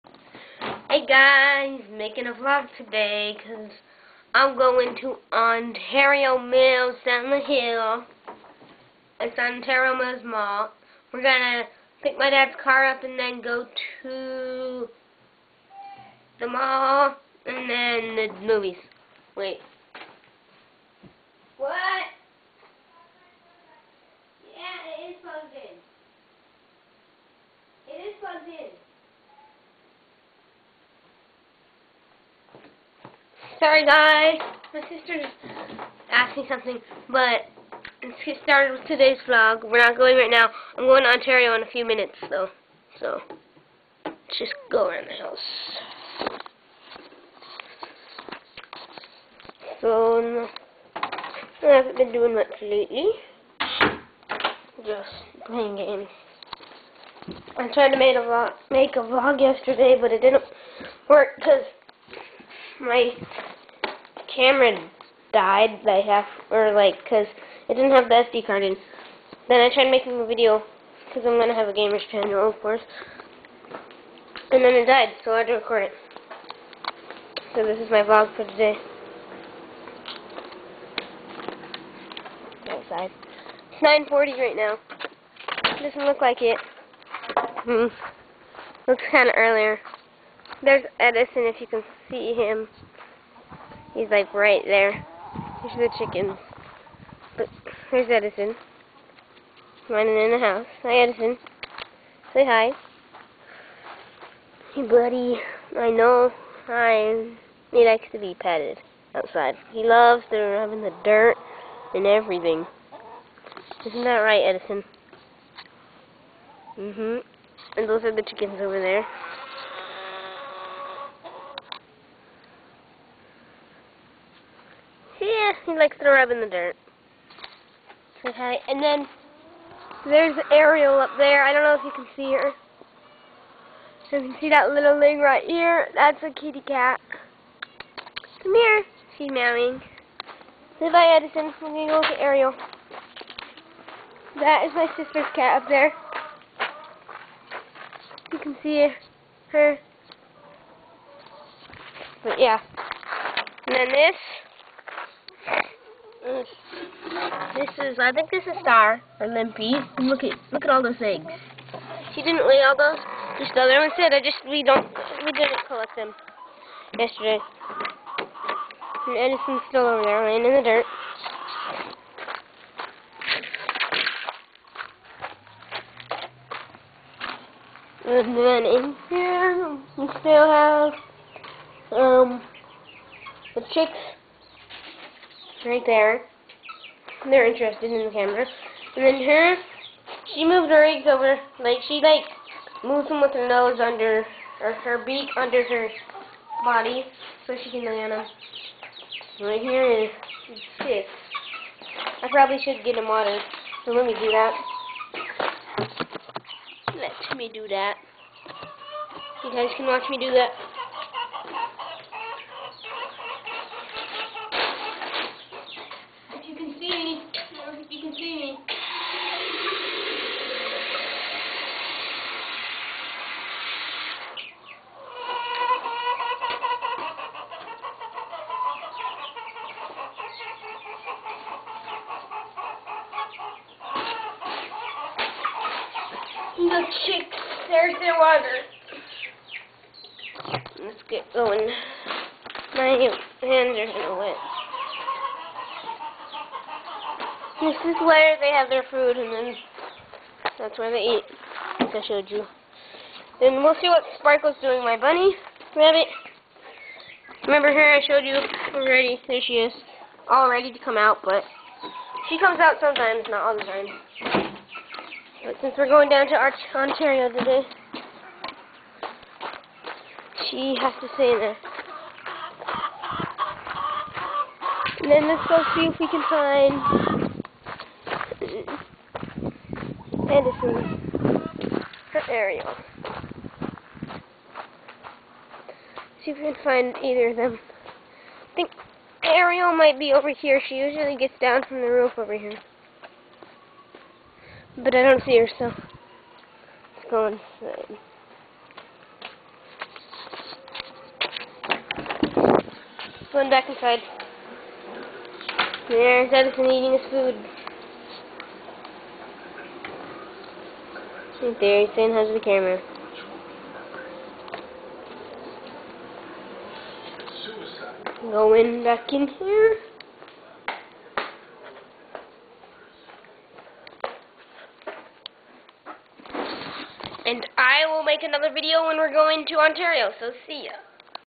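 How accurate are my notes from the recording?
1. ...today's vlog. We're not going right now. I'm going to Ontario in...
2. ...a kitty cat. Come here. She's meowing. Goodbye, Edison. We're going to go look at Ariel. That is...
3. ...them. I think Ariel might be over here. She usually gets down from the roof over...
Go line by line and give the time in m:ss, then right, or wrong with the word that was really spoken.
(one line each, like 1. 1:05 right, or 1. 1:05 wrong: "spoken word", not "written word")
1. 0:38 right
2. 2:16 right
3. 4:47 right.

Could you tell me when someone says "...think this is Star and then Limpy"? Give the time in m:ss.
2:38.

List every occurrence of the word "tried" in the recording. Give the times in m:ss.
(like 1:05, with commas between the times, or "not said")
0:57, 1:09.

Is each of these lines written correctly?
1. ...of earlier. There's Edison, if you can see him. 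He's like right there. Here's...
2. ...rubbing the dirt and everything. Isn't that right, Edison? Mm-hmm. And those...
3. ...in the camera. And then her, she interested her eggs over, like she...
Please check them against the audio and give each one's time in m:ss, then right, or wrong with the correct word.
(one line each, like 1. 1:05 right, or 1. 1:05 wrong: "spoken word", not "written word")
1. 1:29 right
2. 1:50 right
3. 3:07 wrong: "moved", not "interested".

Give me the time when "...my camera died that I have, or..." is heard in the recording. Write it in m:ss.
1:02.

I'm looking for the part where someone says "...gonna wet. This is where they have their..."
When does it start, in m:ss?
4:03.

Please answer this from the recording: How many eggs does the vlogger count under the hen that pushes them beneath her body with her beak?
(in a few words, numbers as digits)
6.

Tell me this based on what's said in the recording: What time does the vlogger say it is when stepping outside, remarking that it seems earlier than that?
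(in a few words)
9:40.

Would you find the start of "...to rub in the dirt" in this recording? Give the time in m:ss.
2:06.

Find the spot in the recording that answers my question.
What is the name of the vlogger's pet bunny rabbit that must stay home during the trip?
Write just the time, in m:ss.
4:14.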